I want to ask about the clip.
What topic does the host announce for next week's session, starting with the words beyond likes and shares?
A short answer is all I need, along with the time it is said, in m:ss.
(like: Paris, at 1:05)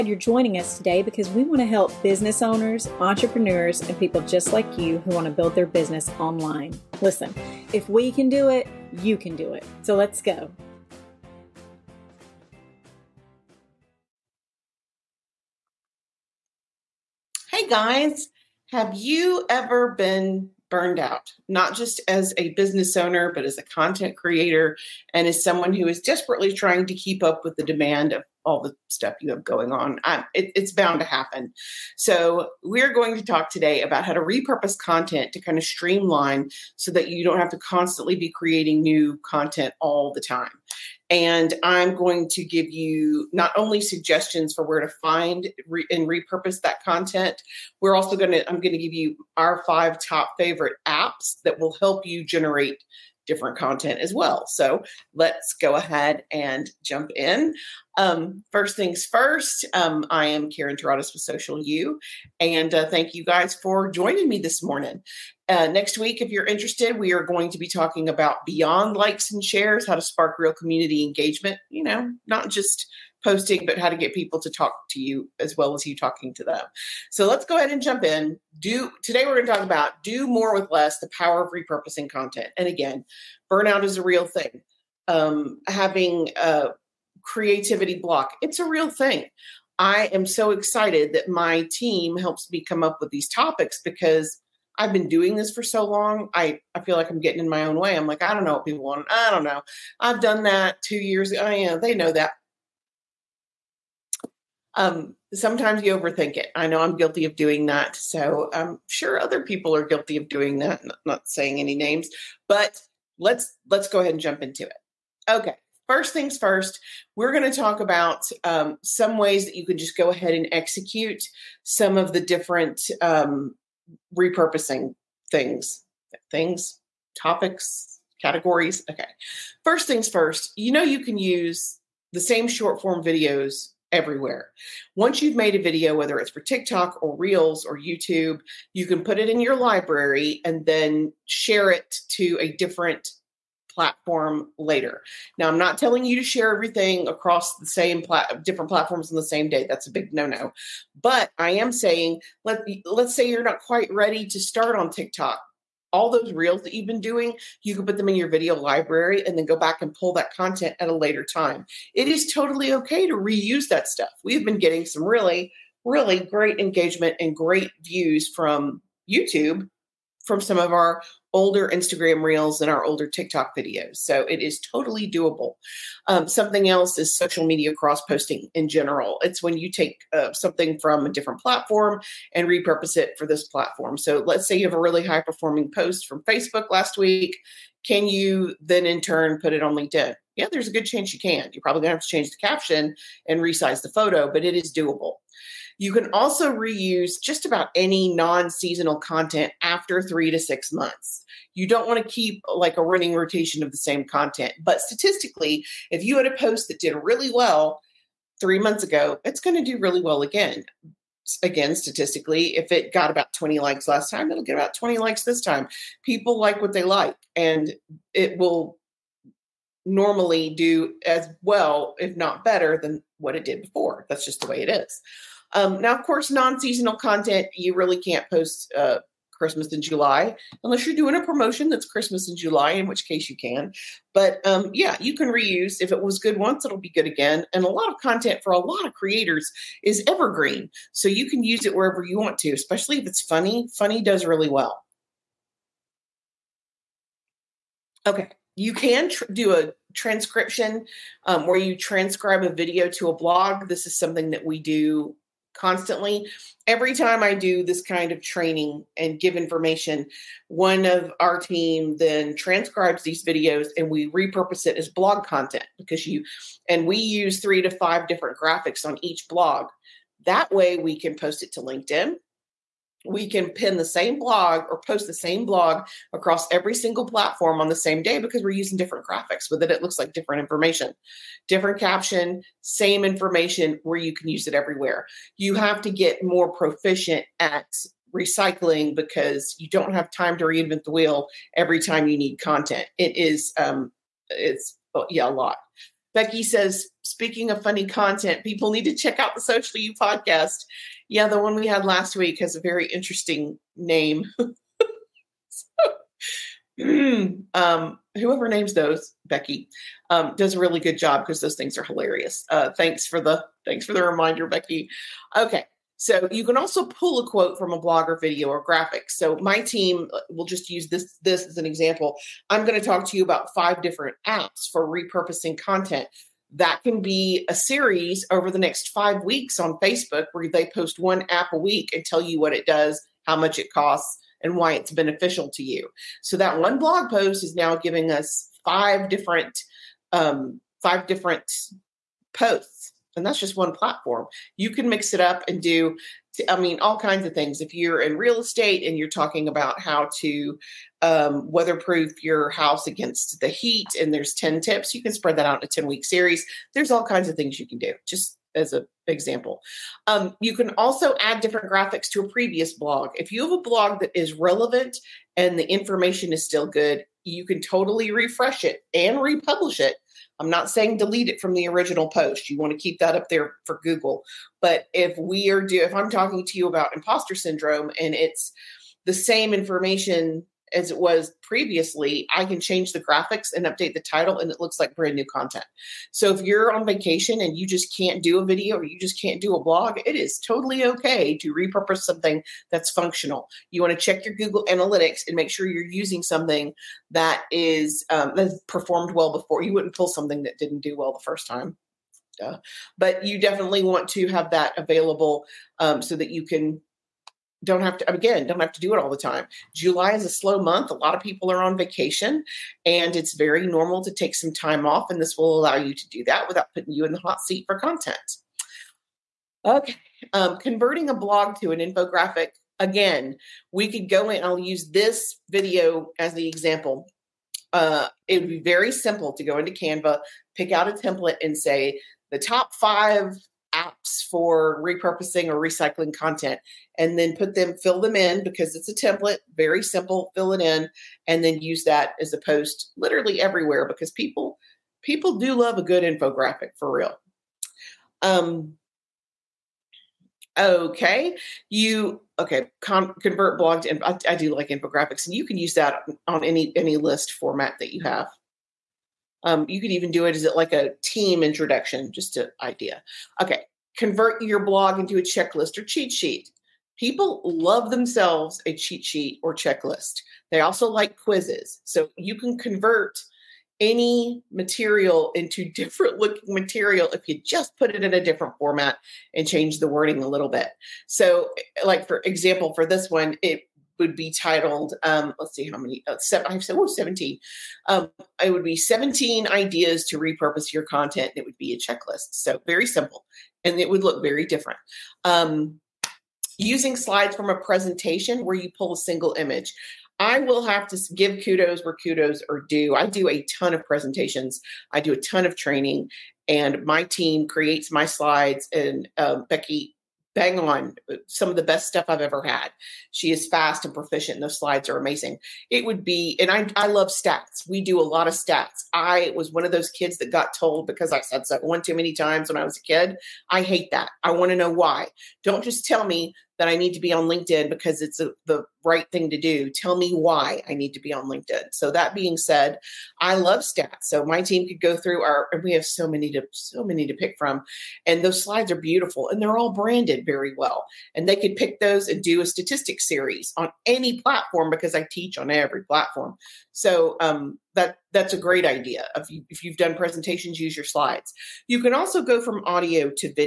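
how to spark real community engagement, at 1:09.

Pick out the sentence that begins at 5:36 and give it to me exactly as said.
So that one blog post is now giving us five different um, five different posts and that's just one platform.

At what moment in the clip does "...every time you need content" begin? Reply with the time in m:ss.
4:51.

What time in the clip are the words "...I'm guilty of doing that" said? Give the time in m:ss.
1:46.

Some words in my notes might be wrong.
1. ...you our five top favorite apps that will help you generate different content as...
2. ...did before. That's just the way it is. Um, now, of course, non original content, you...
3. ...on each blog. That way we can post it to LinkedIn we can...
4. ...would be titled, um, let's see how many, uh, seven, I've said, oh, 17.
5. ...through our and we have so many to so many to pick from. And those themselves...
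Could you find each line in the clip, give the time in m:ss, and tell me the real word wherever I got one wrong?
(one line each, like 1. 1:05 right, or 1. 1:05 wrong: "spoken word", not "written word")
1. 0:48 right
2. 3:43 wrong: "seasonal", not "original"
3. 4:28 right
4. 8:03 right
5. 8:54 wrong: "slides", not "themselves".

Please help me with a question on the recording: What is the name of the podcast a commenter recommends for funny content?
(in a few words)
Socially You.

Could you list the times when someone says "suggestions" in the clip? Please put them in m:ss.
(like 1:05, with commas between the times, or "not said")
0:43.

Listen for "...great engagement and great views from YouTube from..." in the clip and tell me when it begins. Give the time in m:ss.
2:46.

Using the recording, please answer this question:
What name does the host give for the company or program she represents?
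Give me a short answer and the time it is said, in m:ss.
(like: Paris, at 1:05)
Social U, at 1:01.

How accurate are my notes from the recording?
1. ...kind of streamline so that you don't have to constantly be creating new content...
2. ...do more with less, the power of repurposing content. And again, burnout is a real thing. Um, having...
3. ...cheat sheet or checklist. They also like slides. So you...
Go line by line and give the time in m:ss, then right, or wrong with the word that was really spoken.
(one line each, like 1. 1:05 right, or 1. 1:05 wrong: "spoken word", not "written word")
1. 0:35 right
2. 1:20 right
3. 7:48 wrong: "quizzes", not "slides".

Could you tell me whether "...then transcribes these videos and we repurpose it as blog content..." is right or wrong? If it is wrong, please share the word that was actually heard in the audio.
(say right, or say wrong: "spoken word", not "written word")
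right.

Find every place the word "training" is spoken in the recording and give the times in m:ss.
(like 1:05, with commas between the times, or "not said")
4:18, 8:25.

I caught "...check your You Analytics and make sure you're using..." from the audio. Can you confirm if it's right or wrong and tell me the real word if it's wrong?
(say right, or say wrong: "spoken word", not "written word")
wrong: "Google", not "You".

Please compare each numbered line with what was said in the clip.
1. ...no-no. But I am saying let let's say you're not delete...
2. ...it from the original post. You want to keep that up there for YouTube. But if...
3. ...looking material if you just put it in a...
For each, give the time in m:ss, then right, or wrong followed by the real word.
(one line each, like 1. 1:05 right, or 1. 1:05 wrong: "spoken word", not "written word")
1. 2:30 wrong: "quite", not "delete"
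2. 6:11 wrong: "Google", not "YouTube"
3. 7:56 right.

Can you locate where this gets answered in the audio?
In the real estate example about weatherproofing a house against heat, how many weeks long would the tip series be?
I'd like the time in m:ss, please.
5:55.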